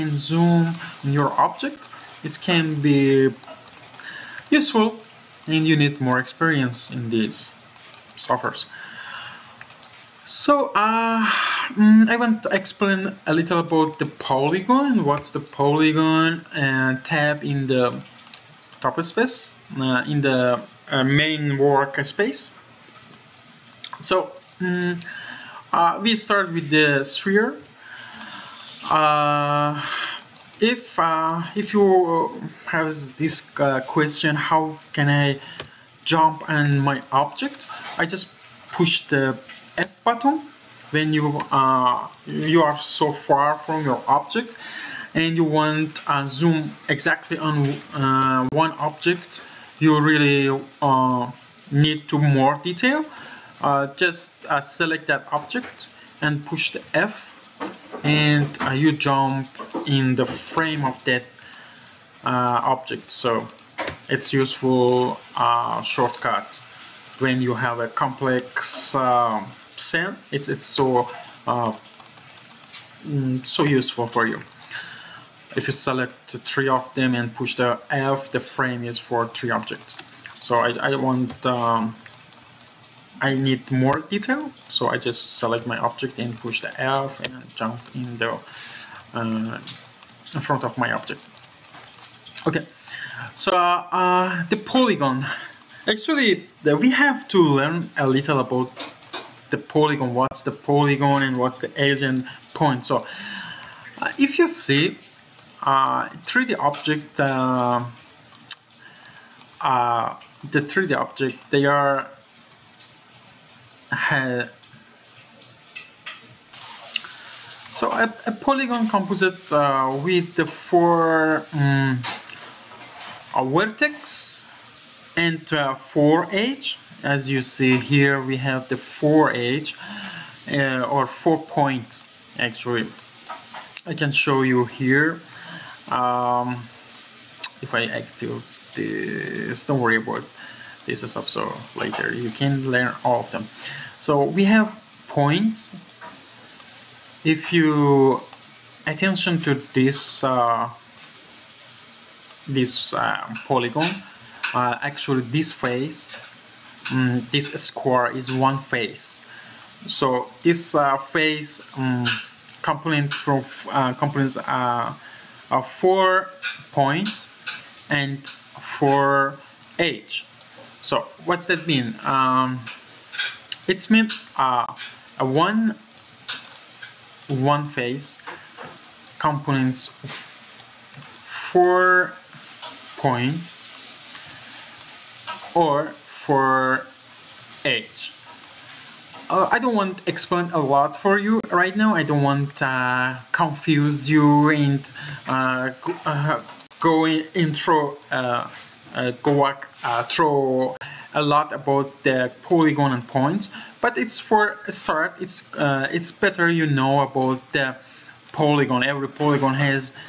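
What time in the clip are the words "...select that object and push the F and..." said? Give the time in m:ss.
0:54.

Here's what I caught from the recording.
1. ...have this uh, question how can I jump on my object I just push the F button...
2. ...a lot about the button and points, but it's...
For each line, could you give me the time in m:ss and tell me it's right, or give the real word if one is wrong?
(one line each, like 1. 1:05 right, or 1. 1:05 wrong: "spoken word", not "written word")
1. 0:32 right
2. 3:21 wrong: "polygon", not "button".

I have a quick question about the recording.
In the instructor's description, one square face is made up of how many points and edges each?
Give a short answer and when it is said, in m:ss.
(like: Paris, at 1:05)
4, at 2:45.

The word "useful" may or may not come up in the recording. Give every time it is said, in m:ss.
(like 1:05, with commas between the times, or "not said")
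0:04, 1:04, 1:13.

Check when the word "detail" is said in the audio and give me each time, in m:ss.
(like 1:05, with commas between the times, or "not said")
0:52, 1:23.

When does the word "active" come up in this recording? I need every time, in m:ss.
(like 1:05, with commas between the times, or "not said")
2:17.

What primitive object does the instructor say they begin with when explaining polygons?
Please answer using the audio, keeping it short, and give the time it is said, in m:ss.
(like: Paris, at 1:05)
Sphere, at 0:27.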